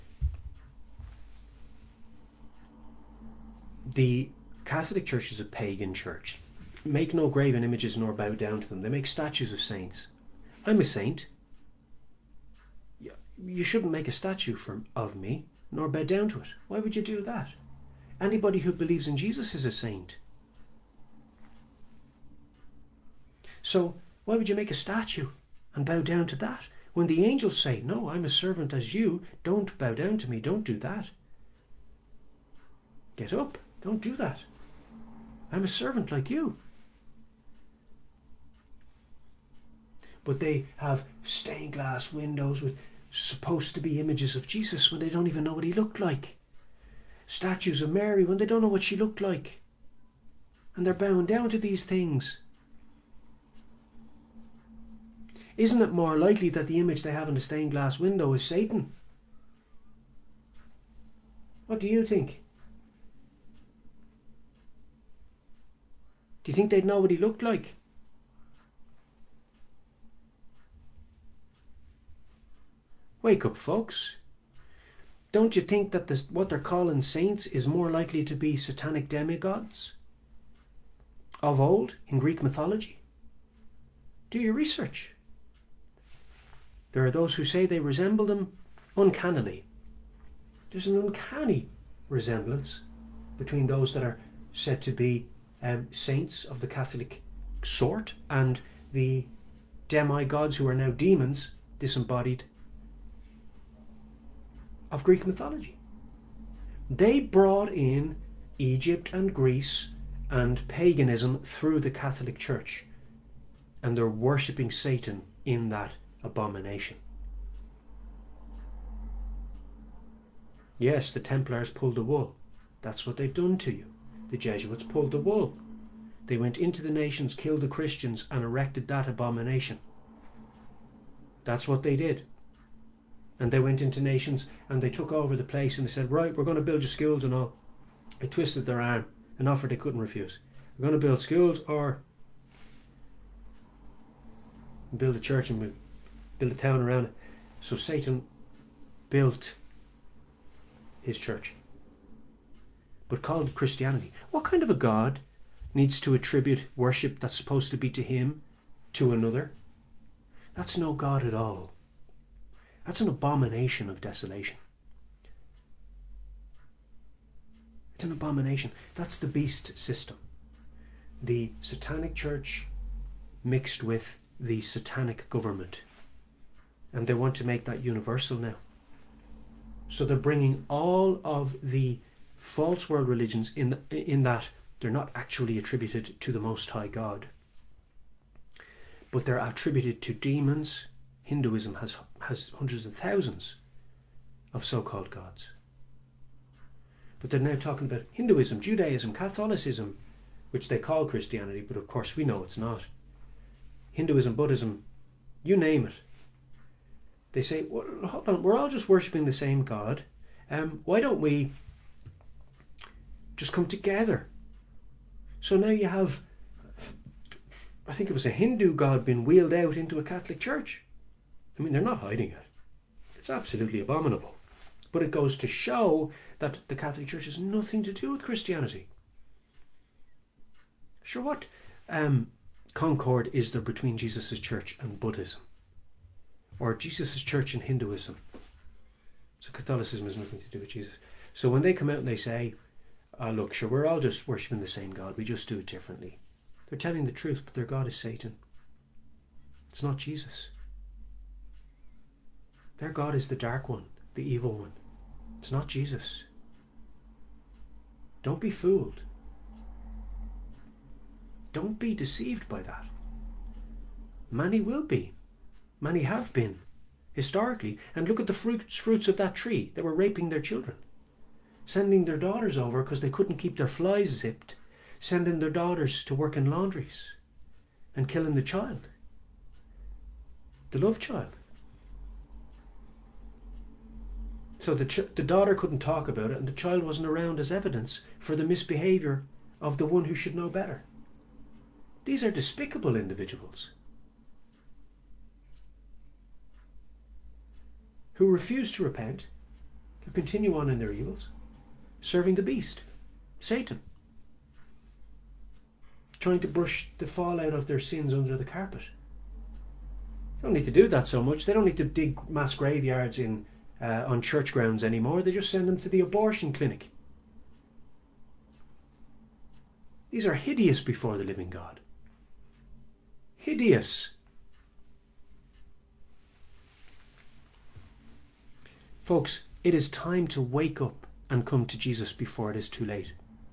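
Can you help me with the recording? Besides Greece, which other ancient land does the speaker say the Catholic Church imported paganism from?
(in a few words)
Egypt.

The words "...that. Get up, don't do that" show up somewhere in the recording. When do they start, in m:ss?
0:30.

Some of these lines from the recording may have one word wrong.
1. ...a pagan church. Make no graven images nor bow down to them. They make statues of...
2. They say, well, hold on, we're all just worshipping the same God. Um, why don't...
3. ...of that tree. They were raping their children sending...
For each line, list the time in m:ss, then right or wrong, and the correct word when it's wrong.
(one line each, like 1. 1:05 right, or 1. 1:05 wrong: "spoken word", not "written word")
1. 0:05 right
2. 3:27 right
3. 4:29 right.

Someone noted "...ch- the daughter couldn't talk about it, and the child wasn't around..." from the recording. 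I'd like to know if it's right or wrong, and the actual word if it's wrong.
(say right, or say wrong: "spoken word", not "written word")
right.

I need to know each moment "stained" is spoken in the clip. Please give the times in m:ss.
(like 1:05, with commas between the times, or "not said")
0:41, 0:57.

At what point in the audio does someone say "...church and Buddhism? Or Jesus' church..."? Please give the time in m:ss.
3:54.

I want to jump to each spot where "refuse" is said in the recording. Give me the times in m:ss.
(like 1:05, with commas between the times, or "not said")
2:19, 4:58.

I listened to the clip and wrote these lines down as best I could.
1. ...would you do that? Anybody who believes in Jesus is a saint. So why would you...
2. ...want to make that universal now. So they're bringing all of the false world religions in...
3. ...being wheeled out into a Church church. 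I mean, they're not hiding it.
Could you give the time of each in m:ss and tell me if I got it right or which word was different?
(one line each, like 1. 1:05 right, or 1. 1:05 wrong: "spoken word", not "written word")
1. 0:16 right
2. 2:57 right
3. 3:39 wrong: "Catholic", not "Church".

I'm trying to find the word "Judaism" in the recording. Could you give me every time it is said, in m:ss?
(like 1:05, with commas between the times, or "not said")
3:18.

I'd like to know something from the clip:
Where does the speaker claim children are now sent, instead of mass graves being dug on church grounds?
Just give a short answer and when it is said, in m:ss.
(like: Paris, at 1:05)
Abortion clinic, at 5:15.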